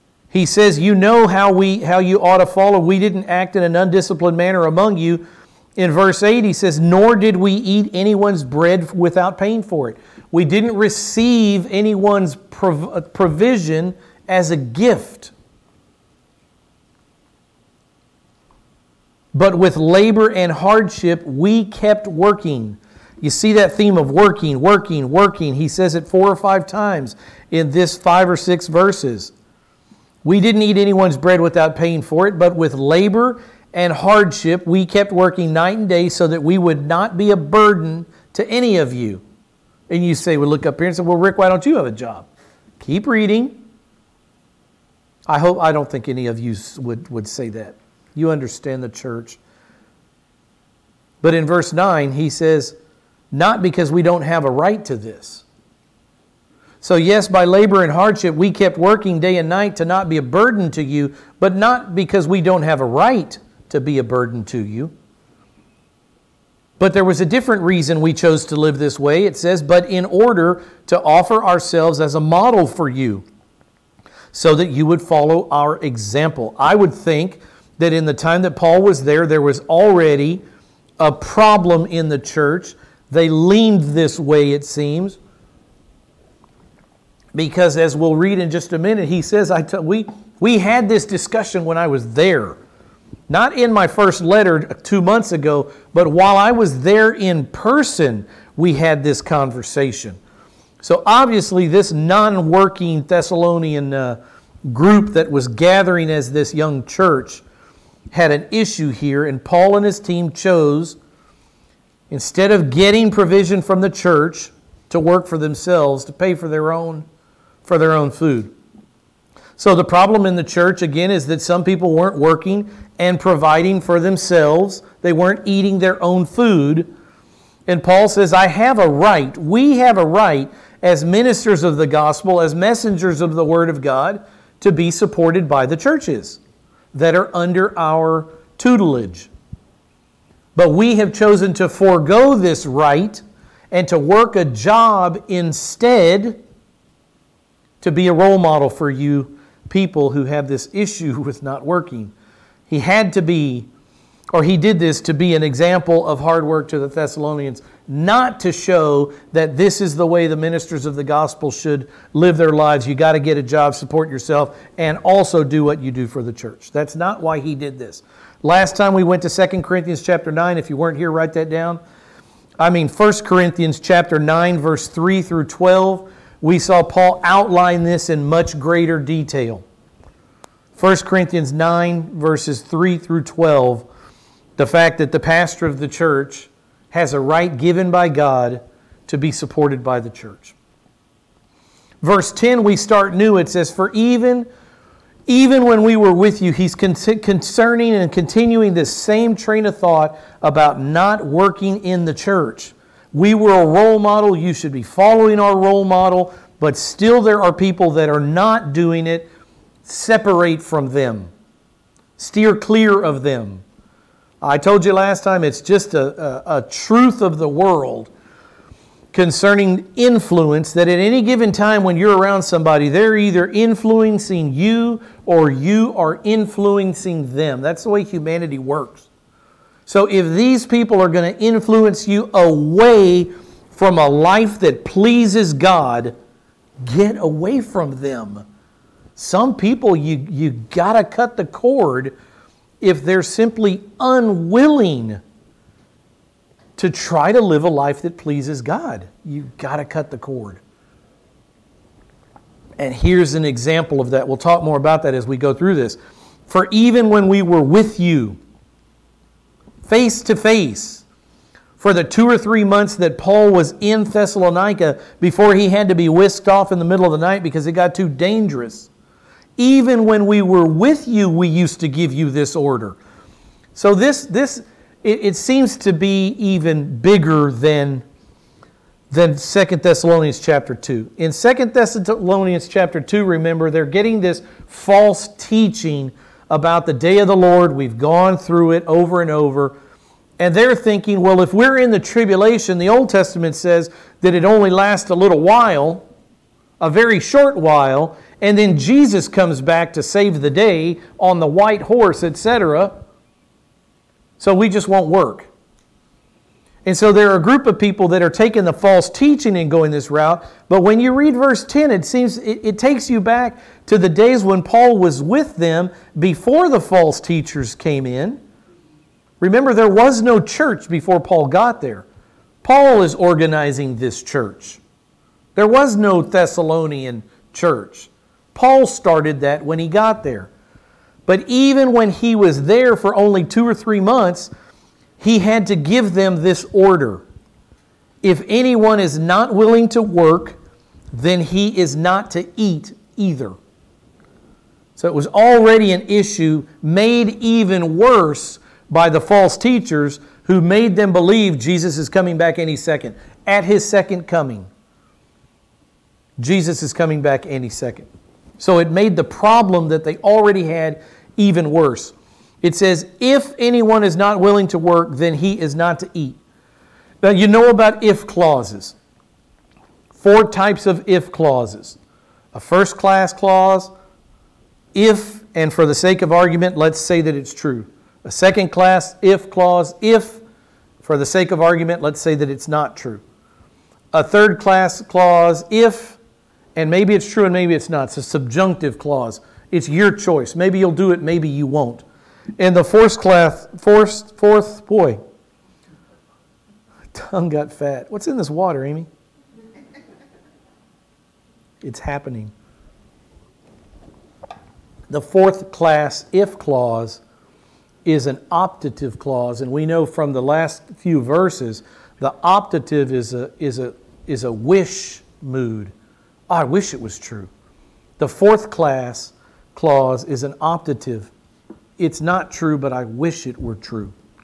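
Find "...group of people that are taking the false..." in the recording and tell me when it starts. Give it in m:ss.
5:07.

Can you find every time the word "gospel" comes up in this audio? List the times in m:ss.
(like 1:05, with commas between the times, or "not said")
2:11, 2:41.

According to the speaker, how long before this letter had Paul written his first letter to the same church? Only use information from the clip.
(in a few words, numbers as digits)
2 months.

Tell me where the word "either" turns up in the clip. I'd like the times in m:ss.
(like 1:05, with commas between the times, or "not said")
3:43, 5:43.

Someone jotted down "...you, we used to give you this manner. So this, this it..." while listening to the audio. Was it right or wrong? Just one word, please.
wrong.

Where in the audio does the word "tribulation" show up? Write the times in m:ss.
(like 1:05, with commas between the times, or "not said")
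4:51.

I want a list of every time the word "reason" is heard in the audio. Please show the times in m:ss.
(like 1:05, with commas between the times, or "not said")
1:07.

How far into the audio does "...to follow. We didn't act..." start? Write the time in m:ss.
0:02.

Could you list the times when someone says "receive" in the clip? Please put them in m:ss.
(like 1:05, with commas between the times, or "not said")
0:10.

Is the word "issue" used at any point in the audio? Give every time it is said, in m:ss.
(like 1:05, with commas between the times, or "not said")
1:48, 2:30, 5:46.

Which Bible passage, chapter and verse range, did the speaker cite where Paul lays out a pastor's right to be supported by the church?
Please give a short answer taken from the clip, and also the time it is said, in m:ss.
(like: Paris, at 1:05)
1 Corinthians 9:3-12, at 2:52.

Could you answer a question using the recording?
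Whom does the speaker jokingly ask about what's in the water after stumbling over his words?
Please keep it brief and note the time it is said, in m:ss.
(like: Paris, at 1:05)
Amy, at 6:38.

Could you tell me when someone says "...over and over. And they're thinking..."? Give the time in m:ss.
4:48.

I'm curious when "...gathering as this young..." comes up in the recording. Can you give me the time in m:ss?
1:45.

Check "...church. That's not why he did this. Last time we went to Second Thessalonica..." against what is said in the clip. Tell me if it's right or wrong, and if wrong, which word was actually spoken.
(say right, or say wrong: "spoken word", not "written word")
wrong: "Corinthians", not "Thessalonica".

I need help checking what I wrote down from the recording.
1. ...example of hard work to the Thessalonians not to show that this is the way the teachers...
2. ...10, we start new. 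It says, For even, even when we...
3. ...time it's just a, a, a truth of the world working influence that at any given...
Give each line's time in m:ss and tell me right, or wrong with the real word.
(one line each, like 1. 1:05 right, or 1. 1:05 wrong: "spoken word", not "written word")
1. 2:35 wrong: "ministers", not "teachers"
2. 3:12 right
3. 3:35 wrong: "concerning", not "working".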